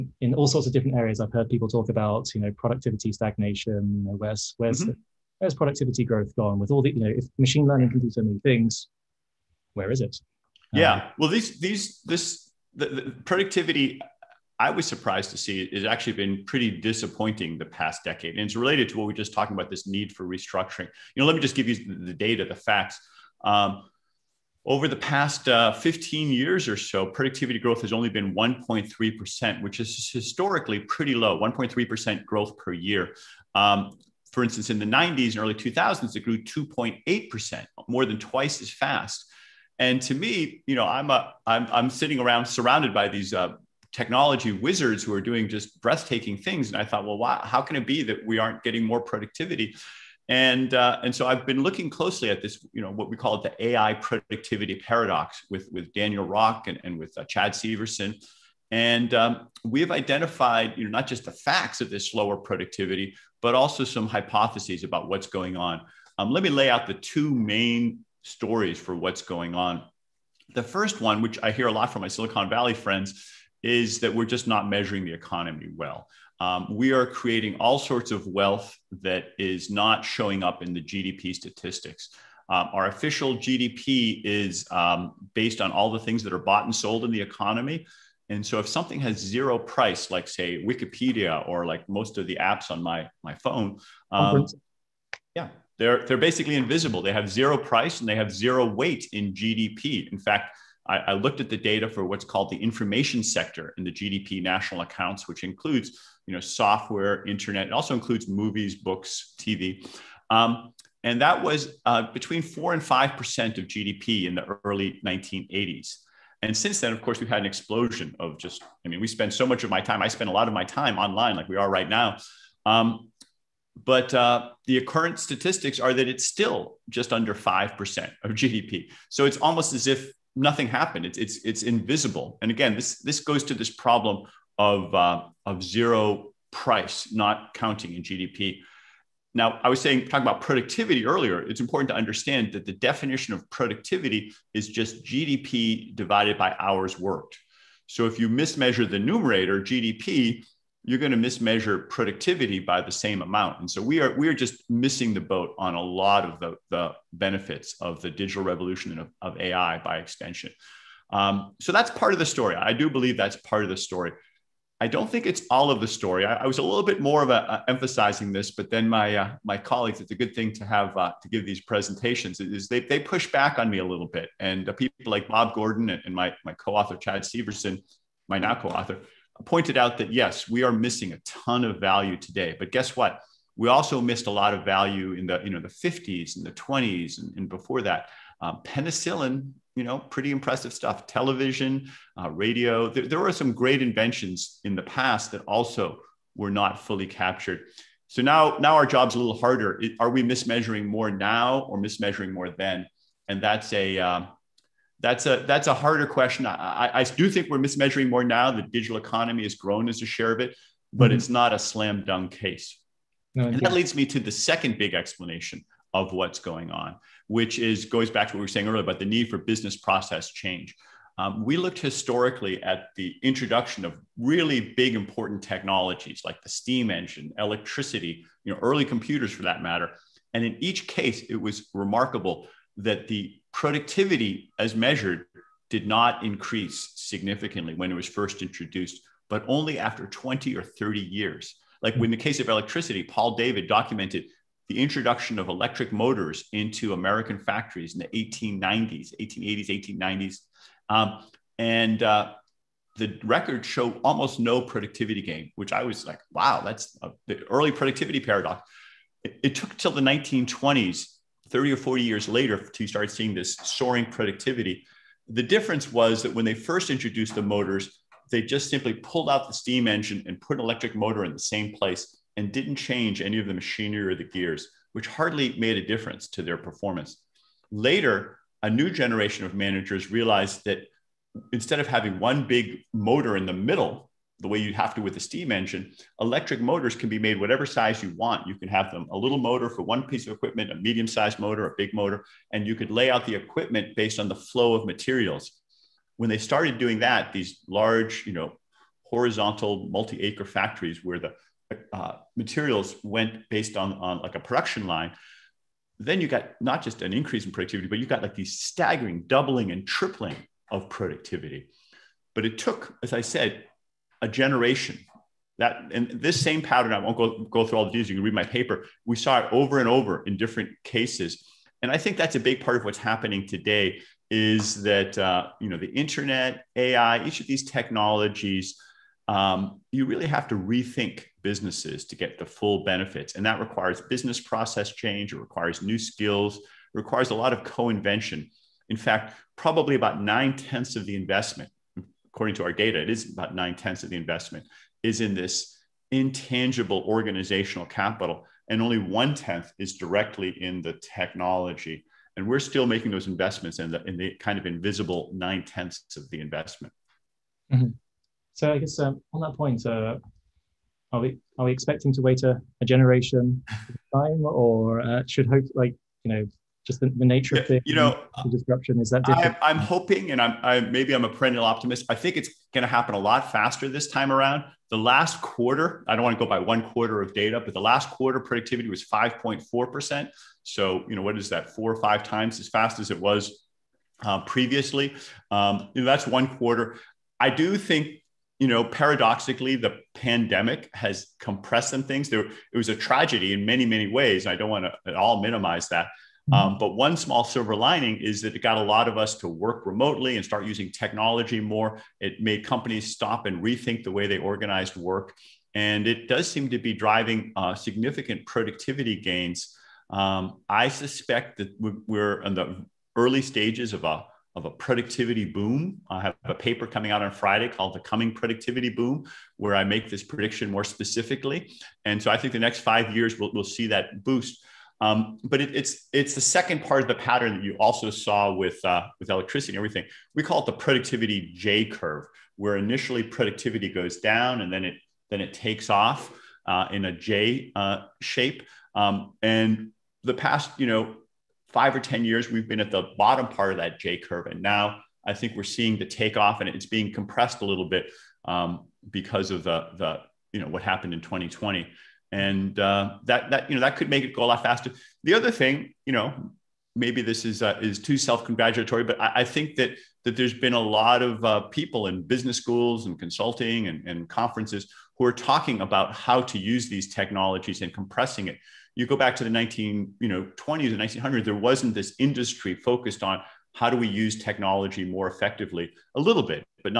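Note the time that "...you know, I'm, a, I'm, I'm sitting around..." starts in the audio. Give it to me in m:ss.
0:40.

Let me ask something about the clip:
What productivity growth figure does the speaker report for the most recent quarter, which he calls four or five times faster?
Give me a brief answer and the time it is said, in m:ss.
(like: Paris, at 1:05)
5.4%, at 6:19.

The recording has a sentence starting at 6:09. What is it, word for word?
I, am hoping, and I'm I, maybe I'm a perennial optimist.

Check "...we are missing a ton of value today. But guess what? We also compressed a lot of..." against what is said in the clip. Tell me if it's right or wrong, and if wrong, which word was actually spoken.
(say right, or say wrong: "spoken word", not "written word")
wrong: "missed", not "compressed".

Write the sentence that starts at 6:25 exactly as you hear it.
Um, you know, that's one quarter.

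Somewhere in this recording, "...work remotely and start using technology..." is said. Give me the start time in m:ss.
6:39.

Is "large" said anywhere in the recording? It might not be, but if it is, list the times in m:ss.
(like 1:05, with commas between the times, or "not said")
4:57.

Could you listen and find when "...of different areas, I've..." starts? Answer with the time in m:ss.
0:00.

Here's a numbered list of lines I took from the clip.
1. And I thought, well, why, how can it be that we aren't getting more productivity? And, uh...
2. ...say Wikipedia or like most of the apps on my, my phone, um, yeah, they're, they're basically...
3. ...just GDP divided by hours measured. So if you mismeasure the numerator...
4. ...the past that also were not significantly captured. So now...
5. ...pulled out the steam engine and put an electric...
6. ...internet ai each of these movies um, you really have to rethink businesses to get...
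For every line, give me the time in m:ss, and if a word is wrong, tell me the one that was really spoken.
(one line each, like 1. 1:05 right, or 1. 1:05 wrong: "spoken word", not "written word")
1. 0:46 right
2. 1:30 right
3. 2:24 wrong: "worked", not "measured"
4. 3:14 wrong: "fully", not "significantly"
5. 4:28 right
6. 5:25 wrong: "technologies", not "movies".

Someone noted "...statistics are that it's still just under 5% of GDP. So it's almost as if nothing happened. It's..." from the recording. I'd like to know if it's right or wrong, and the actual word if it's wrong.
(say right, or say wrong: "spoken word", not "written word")
right.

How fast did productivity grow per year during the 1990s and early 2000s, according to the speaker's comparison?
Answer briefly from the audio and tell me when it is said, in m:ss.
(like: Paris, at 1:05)
2.8%, at 0:36.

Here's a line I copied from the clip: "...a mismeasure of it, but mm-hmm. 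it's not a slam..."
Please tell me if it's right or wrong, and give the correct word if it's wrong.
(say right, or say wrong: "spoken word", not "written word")
wrong: "share", not "mismeasure".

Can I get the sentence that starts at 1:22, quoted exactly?
Um, our official GDP is um, based on all the things that are bought and sold in the economy.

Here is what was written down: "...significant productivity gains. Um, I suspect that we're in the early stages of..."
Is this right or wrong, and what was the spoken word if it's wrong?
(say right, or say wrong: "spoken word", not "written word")
right.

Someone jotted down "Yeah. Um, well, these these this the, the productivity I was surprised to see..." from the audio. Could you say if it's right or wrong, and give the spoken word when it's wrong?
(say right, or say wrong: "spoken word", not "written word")
right.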